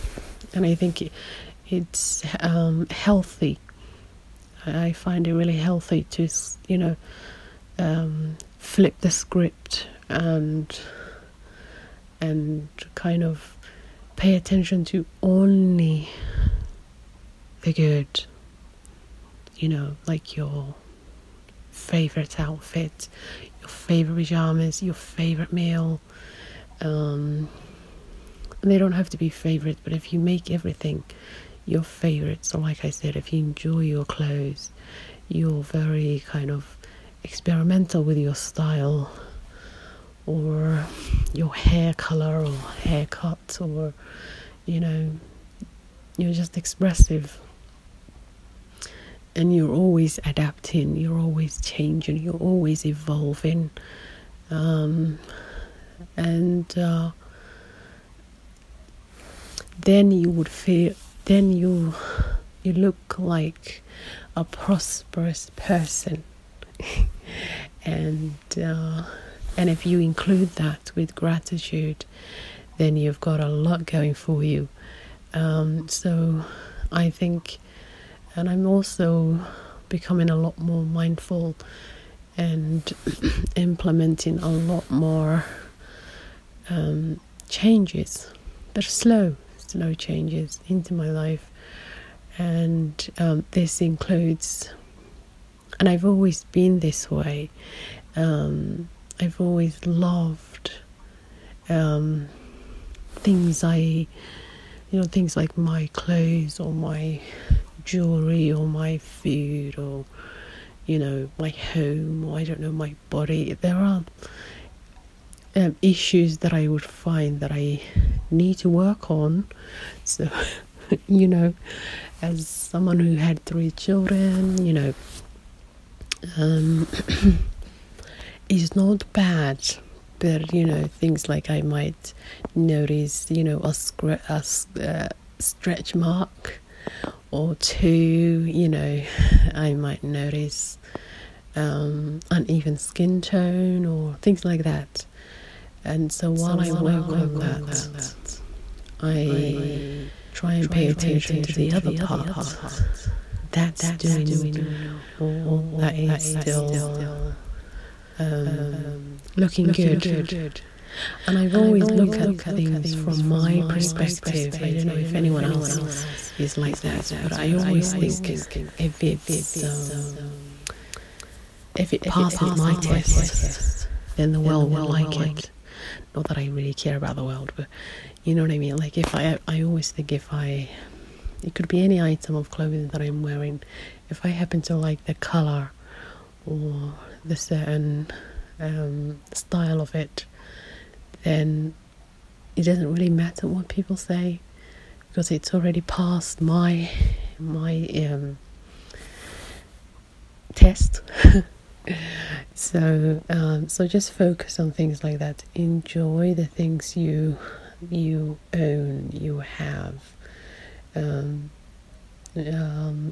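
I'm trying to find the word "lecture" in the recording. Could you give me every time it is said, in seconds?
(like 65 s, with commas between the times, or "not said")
not said.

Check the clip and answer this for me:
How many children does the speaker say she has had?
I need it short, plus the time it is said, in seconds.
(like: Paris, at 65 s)
3, at 123 s.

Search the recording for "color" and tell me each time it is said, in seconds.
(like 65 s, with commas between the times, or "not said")
41 s, 185 s.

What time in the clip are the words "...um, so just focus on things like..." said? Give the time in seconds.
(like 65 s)
203 s.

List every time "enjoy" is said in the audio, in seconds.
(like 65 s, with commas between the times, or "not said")
33 s, 205 s.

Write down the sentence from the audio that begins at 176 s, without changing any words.
Not that I really care about the world, but you know what I mean.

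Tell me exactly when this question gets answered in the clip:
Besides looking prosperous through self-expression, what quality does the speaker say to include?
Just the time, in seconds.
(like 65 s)
71 s.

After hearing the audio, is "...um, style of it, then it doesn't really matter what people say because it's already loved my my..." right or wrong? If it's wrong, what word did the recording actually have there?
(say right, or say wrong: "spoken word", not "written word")
wrong: "passed", not "loved".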